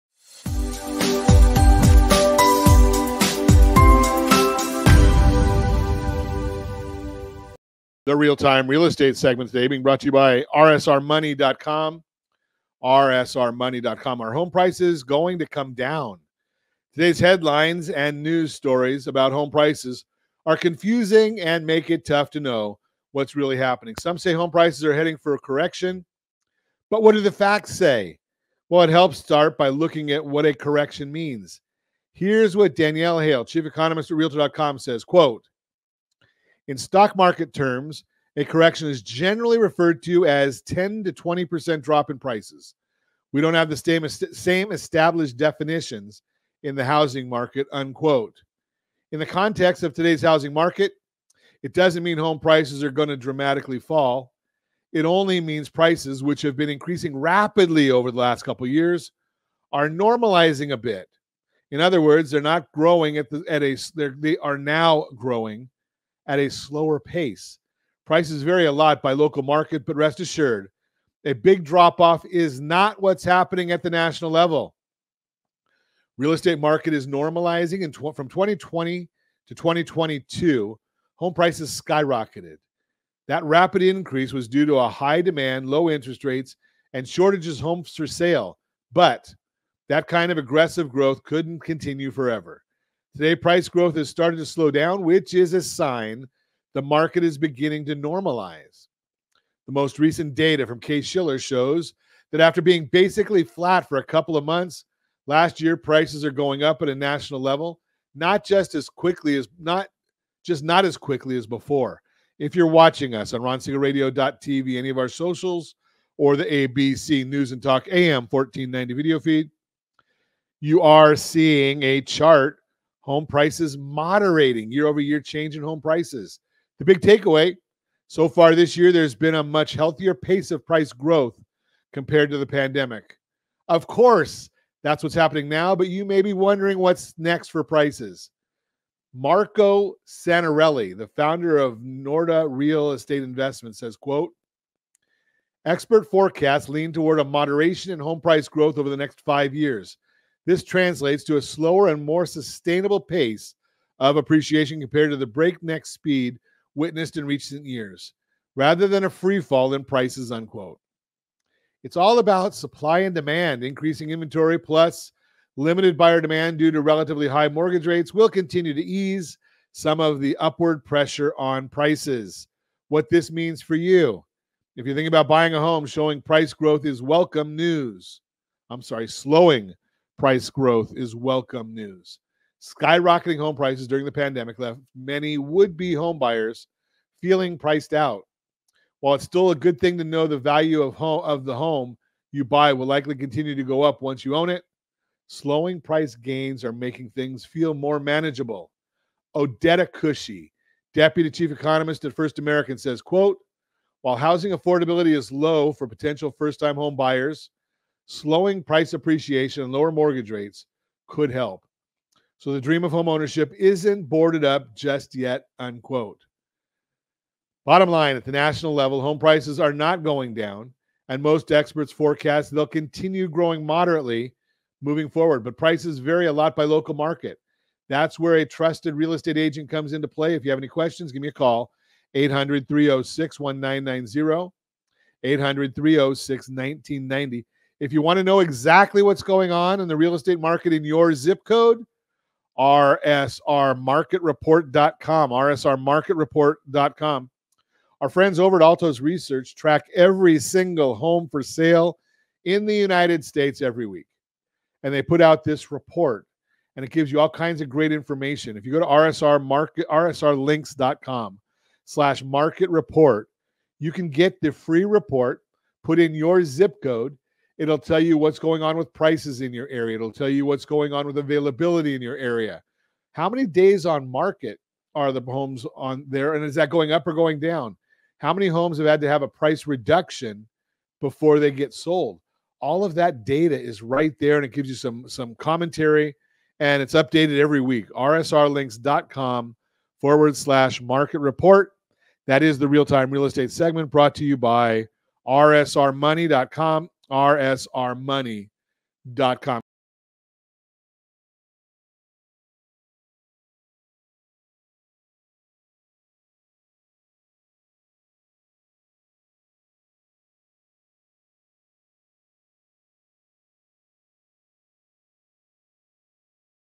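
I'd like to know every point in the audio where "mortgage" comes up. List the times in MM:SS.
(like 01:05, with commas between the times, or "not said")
02:47, 03:29.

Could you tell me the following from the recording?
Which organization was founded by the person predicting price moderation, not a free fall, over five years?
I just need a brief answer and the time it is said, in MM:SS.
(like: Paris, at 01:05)
Norada Real Estate Investment, at 02:21.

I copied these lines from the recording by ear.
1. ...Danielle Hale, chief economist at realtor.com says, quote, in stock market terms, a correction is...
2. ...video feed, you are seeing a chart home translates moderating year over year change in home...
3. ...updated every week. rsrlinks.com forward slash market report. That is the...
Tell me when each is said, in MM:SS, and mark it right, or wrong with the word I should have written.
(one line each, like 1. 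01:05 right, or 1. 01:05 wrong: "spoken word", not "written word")
1. 00:32 right
2. 01:58 wrong: "prices", not "translates"
3. 04:46 right.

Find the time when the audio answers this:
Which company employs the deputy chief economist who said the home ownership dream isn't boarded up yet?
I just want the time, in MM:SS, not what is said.
03:22.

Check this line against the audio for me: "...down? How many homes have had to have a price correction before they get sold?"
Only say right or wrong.
wrong.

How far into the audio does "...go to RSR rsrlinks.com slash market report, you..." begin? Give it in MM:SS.
04:18.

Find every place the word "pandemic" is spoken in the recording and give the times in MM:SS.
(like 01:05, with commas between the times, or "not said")
02:12, 03:04.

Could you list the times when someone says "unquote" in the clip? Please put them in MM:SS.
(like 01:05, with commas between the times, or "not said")
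00:47, 02:40, 03:35.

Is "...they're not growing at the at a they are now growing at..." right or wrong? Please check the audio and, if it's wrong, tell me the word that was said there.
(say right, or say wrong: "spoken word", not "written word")
right.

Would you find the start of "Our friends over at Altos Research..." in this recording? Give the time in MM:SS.
04:08.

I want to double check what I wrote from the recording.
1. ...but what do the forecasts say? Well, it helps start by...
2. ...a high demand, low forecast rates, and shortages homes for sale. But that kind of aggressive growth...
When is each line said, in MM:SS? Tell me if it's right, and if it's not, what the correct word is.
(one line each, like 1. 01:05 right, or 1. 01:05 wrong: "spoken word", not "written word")
1. 00:26 wrong: "facts", not "forecasts"
2. 01:24 wrong: "interest", not "forecast".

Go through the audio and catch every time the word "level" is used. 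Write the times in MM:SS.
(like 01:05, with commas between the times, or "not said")
01:14, 01:47, 03:38.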